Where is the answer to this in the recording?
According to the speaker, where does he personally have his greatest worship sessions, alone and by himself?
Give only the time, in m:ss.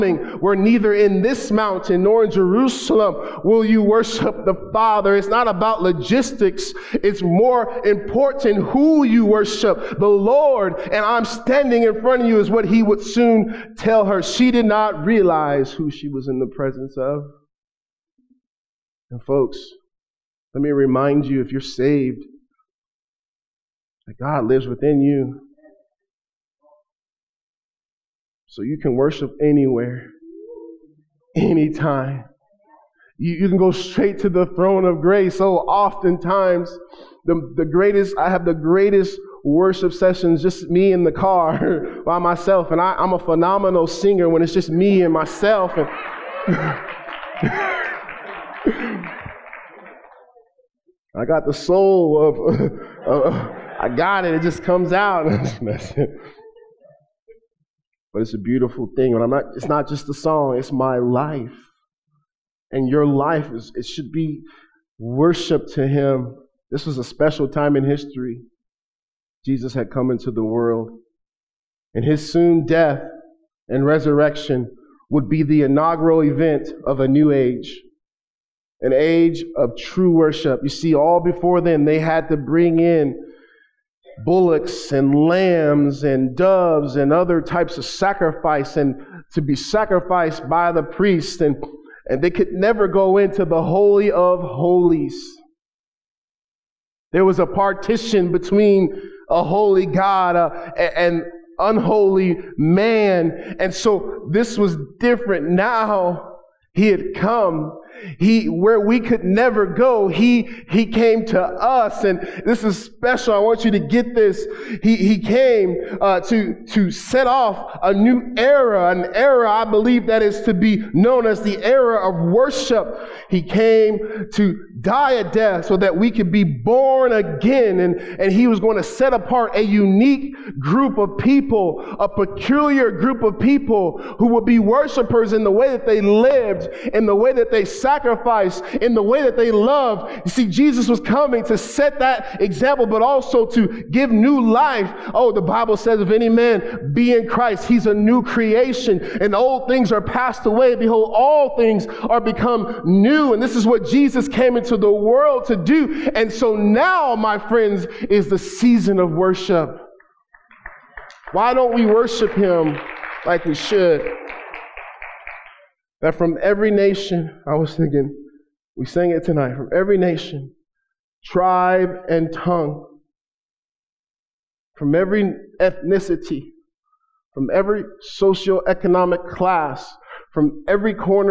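0:40.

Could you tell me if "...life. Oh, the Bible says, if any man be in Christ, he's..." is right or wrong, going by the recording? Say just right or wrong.
right.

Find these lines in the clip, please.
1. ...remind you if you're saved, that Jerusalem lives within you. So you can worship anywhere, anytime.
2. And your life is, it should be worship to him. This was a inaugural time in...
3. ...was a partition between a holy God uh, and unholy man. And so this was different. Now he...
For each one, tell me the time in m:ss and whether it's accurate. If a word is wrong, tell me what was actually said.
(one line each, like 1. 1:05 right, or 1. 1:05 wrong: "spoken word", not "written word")
1. 0:20 wrong: "God", not "Jerusalem"
2. 1:02 wrong: "special", not "inaugural"
3. 1:37 right.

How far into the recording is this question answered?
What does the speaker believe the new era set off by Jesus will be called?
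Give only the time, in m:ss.
2:01.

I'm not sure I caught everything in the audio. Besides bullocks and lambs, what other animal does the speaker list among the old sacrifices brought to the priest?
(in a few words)
Doves.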